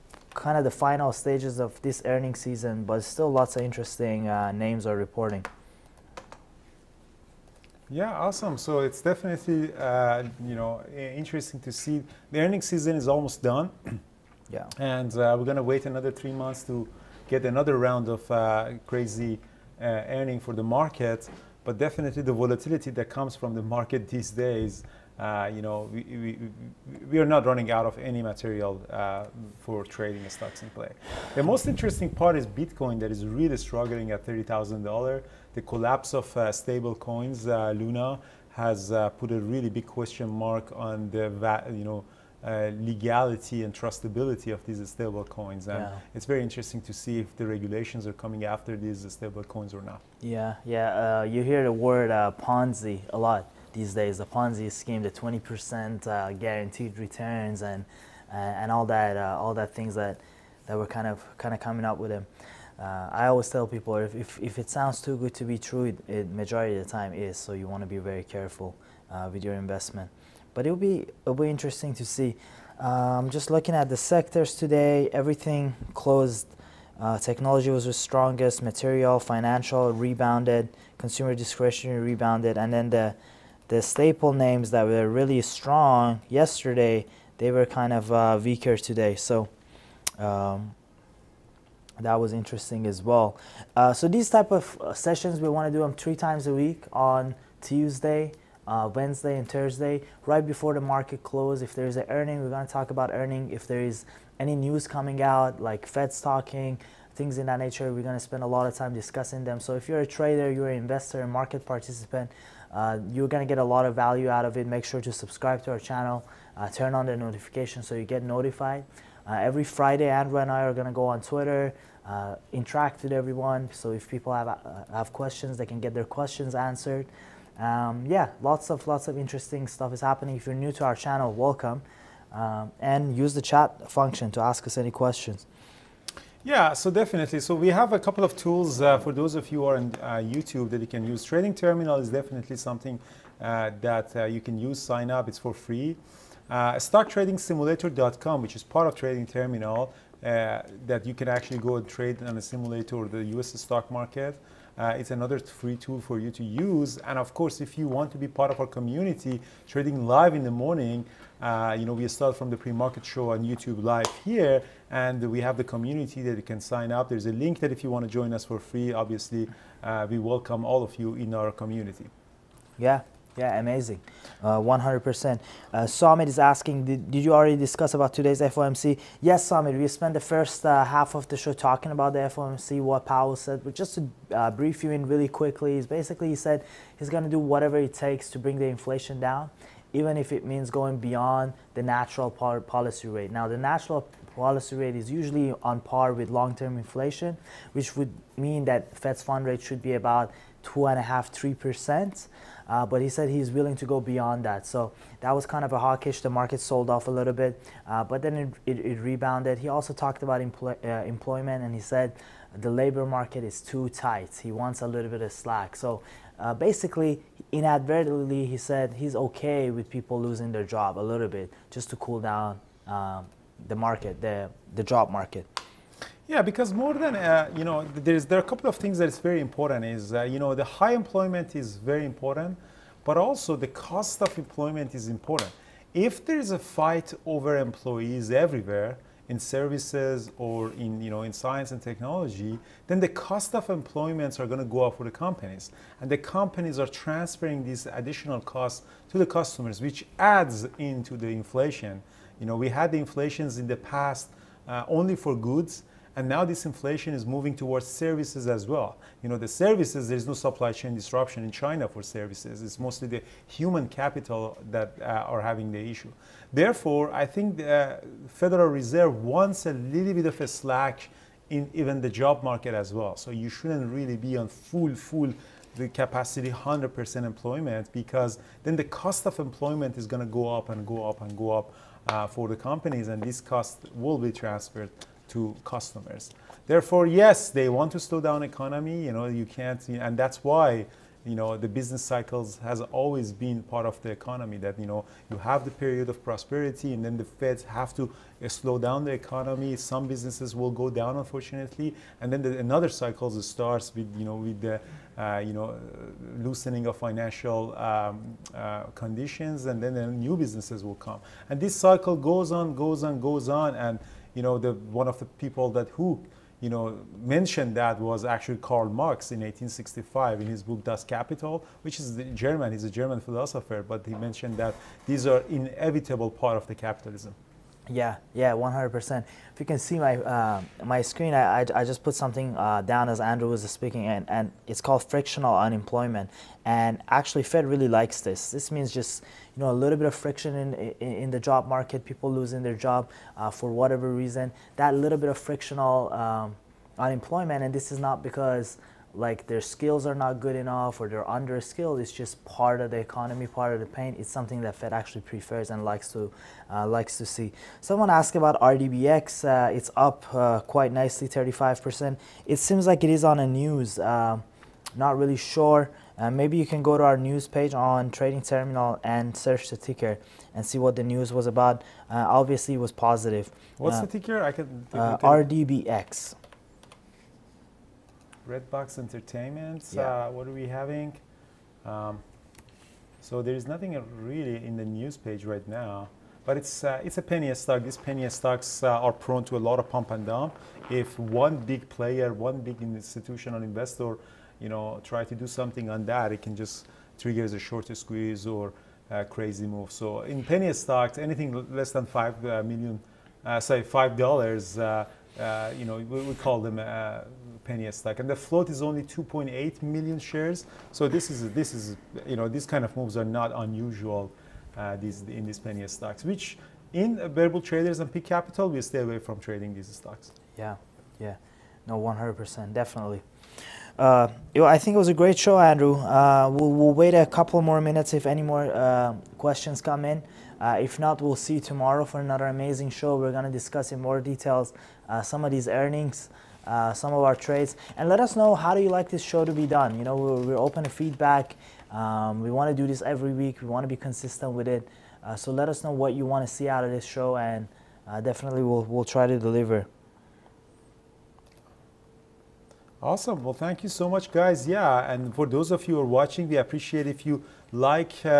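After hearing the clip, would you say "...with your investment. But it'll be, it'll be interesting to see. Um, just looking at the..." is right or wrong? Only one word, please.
right.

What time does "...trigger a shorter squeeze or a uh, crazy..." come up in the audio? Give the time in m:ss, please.
6:37.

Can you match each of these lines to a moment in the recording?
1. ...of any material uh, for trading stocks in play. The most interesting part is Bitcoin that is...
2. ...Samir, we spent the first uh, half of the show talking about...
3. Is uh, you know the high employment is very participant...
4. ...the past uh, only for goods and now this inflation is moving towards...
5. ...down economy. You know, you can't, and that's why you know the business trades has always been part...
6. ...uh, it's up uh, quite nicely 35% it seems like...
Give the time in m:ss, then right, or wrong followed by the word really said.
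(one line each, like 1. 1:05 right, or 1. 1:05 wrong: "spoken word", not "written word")
1. 0:27 right
2. 2:59 right
3. 3:49 wrong: "important", not "participant"
4. 4:13 right
5. 4:48 wrong: "cycles", not "trades"
6. 5:59 right.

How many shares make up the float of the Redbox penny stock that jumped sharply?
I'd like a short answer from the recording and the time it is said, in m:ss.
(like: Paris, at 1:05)
2.8 million, at 6:49.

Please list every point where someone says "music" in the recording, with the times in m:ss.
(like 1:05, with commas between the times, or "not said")
not said.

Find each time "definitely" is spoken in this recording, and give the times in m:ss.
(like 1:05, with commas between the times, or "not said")
0:09, 0:21, 2:16, 2:22, 7:02, 7:28.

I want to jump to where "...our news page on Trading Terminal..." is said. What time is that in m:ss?
6:07.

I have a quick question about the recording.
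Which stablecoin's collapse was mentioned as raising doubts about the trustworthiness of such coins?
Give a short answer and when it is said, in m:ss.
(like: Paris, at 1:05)
Luna, at 0:37.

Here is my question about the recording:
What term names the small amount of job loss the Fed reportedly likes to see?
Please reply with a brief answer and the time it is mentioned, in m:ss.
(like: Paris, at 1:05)
Frictional unemployment, at 5:35.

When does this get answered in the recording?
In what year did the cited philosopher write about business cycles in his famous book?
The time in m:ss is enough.
5:19.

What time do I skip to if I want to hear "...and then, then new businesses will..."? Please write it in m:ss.
5:09.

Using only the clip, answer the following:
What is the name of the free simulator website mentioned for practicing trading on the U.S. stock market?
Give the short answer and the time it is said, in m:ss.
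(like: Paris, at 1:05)
StockTradingSimulator.com, at 2:26.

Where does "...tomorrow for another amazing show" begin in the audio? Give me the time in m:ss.
7:11.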